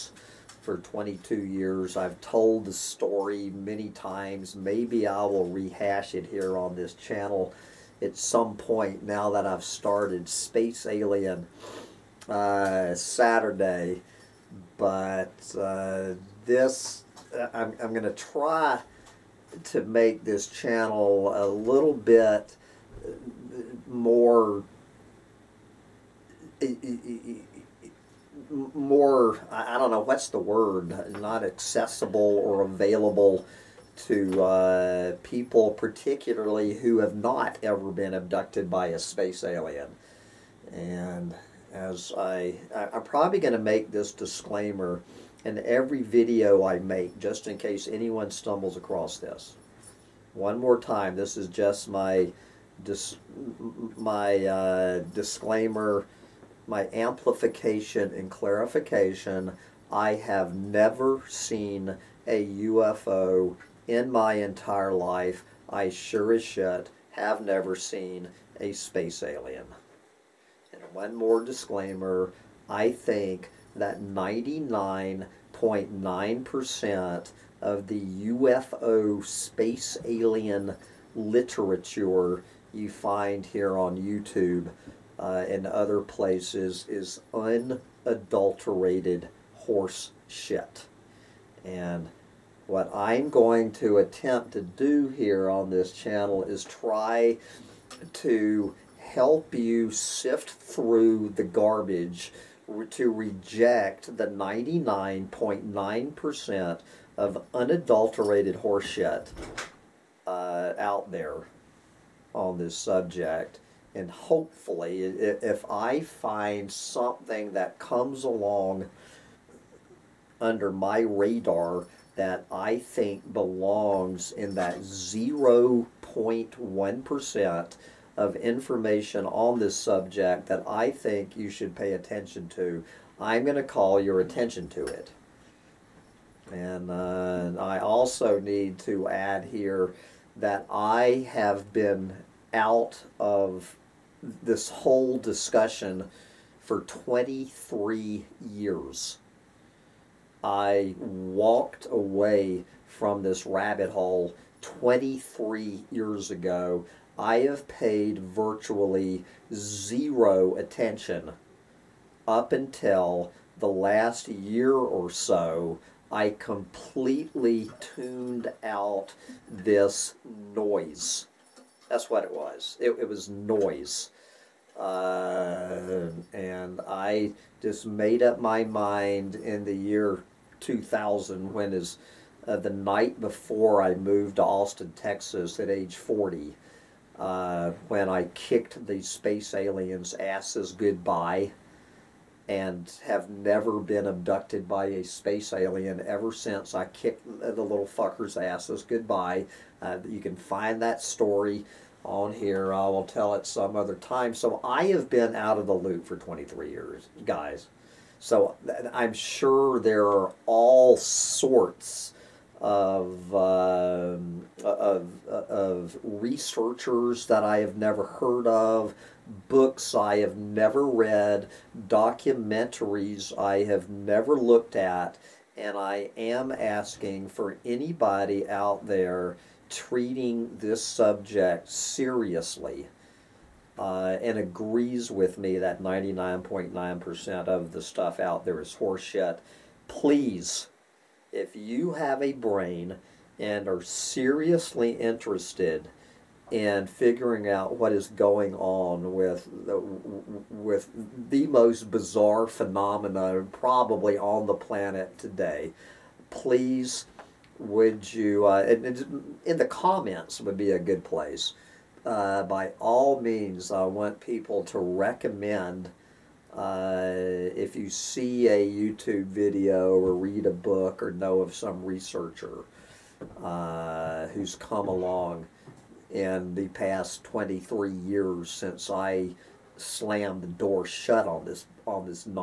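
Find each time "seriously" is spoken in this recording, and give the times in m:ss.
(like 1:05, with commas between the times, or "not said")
3:51, 4:03.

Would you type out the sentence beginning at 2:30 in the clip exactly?
I walked away from this rabbit hole 23 years ago.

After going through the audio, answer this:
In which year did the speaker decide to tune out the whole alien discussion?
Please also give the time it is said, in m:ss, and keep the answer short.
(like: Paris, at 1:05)
2000, at 3:00.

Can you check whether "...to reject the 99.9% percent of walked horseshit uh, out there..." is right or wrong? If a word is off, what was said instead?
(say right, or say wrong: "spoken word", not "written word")
wrong: "unadulterated", not "walked".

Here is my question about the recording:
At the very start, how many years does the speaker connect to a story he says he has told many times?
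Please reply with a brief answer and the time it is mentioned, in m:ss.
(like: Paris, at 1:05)
22 years, at 0:00.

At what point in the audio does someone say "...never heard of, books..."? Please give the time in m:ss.
3:37.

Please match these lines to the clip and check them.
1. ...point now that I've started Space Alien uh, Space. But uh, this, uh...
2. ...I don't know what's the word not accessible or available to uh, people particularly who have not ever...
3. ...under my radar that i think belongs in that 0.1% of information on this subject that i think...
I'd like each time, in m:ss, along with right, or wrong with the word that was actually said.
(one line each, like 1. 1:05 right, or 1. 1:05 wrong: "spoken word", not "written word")
1. 0:08 wrong: "Saturday", not "Space"
2. 0:29 right
3. 2:00 right.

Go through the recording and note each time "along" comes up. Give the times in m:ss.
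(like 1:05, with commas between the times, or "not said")
1:58, 4:34.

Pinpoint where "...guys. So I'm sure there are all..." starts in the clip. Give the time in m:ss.
3:27.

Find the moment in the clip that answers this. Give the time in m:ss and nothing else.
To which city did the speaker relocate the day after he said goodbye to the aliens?
3:04.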